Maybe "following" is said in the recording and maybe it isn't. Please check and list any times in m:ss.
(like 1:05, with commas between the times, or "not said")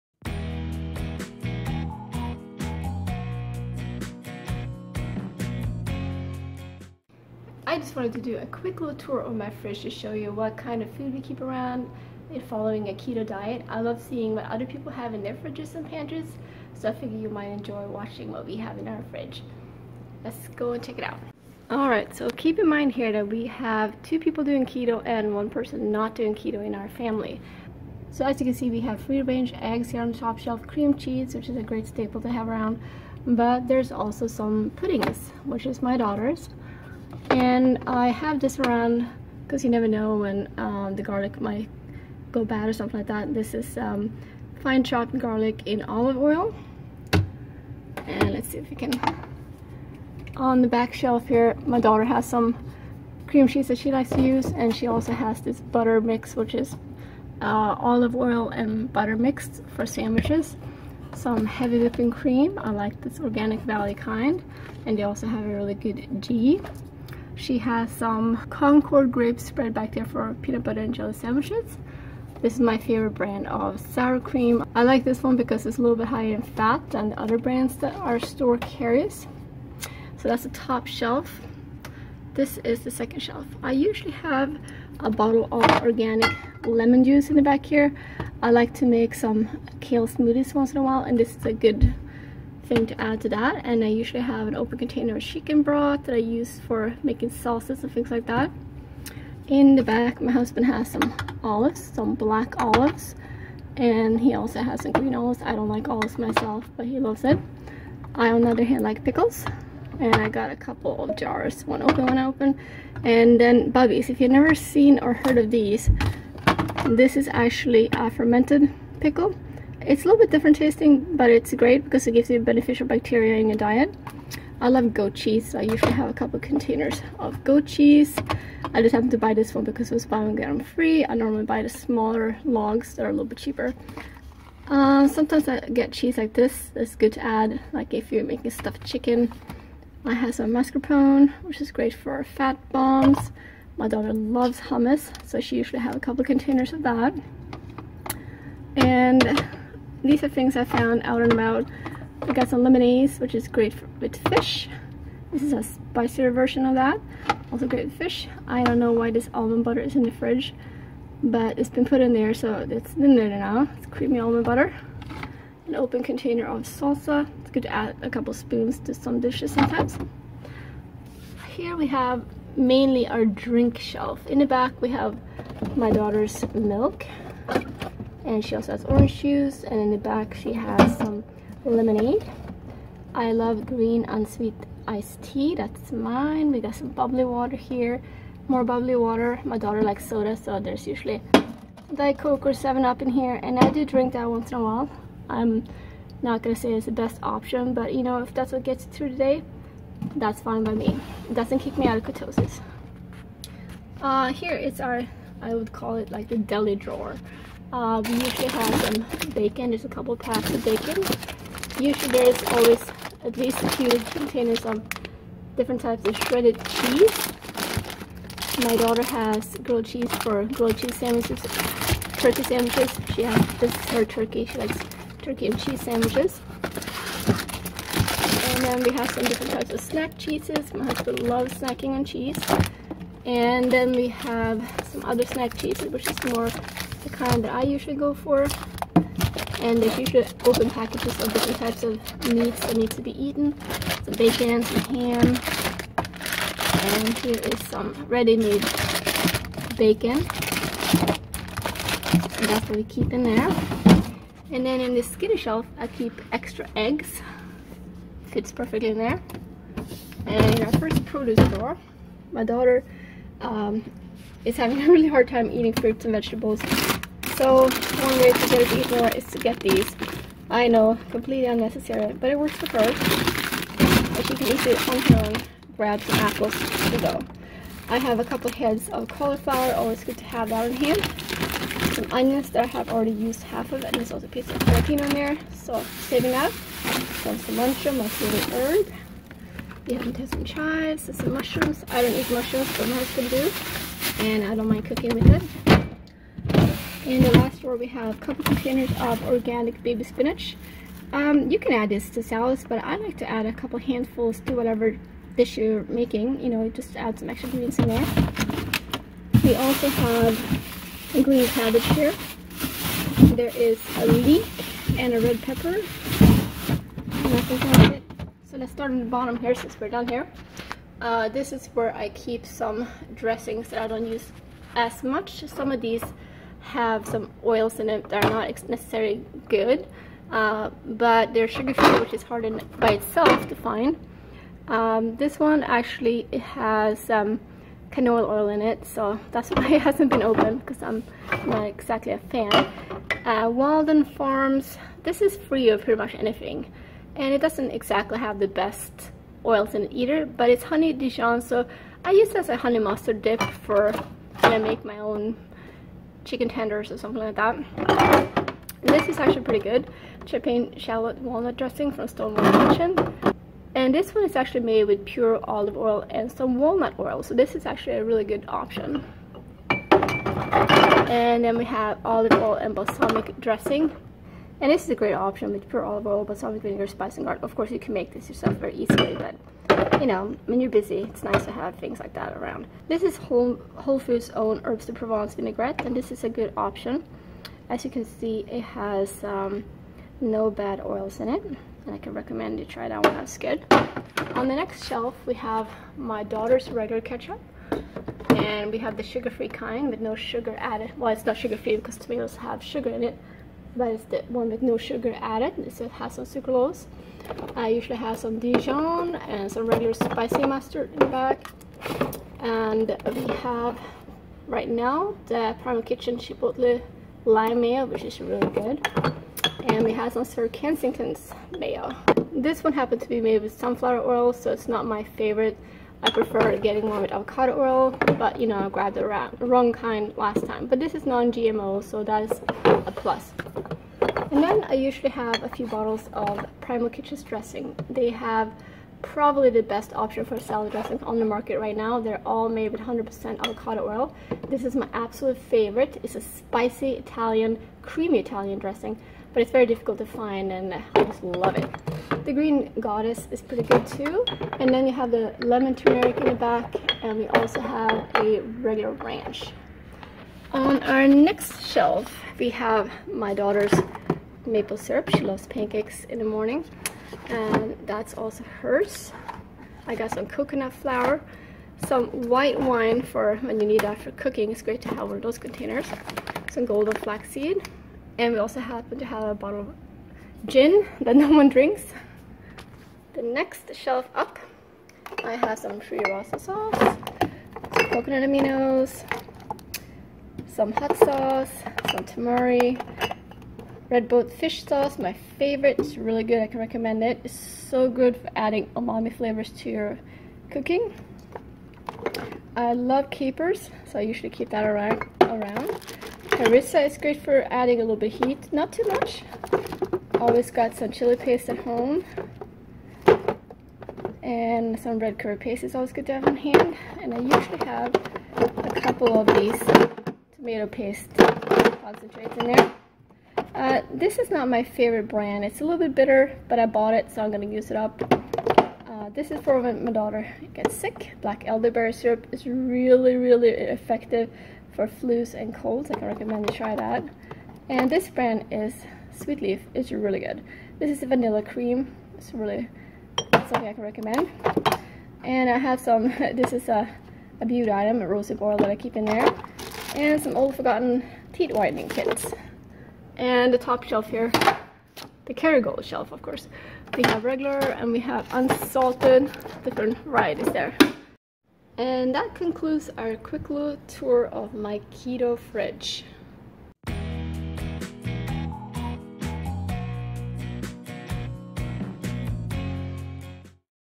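0:12.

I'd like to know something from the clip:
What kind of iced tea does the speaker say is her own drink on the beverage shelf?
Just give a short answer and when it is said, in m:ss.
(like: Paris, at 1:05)
Green unsweet iced tea, at 3:03.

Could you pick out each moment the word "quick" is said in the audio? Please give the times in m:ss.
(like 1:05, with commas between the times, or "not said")
0:08, 9:23.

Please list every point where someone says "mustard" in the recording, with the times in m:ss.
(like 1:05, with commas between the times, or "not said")
5:52, 6:50.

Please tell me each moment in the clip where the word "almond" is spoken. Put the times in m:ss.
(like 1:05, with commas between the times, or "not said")
2:39, 2:44.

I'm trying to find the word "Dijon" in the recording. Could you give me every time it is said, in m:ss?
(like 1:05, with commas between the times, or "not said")
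5:50, 6:48.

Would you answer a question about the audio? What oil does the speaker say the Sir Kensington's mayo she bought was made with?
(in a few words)
Sunflower oil.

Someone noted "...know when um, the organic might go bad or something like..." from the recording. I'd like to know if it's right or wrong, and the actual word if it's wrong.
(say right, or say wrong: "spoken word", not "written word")
wrong: "garlic", not "organic".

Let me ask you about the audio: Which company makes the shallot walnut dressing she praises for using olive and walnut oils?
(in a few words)
Stonewall Kitchen.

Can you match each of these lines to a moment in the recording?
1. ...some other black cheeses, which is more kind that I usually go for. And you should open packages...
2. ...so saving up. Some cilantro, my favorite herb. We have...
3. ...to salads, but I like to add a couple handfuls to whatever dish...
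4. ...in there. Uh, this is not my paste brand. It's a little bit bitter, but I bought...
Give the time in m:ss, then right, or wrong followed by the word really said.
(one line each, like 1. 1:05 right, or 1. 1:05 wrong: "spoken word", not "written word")
1. 3:54 wrong: "snack", not "black"
2. 4:45 right
3. 5:02 right
4. 8:42 wrong: "favorite", not "paste".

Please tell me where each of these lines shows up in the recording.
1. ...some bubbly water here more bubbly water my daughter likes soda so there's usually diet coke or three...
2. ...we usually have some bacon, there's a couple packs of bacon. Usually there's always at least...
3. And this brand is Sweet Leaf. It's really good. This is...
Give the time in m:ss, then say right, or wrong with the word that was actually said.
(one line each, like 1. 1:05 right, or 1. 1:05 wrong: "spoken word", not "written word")
1. 3:06 wrong: "seven", not "three"
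2. 3:28 right
3. 8:57 right.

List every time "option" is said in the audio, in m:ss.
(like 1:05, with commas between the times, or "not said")
3:17, 6:08, 6:15, 6:26, 7:19.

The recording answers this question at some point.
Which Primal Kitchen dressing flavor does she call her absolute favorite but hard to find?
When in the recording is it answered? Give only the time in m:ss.
7:26.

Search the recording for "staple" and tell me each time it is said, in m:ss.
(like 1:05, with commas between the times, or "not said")
0:31.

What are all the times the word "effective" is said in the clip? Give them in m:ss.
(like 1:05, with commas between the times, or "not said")
8:53.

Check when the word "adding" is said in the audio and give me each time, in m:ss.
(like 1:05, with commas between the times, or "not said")
8:18, 8:27.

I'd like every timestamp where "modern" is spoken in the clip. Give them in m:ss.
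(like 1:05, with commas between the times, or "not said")
not said.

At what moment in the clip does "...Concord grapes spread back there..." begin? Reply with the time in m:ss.
1:08.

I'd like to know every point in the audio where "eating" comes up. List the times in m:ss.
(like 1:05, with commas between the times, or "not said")
4:25.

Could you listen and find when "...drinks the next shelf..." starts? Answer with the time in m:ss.
8:01.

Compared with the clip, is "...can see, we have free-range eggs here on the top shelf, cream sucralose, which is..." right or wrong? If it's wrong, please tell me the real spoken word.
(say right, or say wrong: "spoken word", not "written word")
wrong: "cheese", not "sucralose".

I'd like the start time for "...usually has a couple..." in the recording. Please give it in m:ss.
2:25.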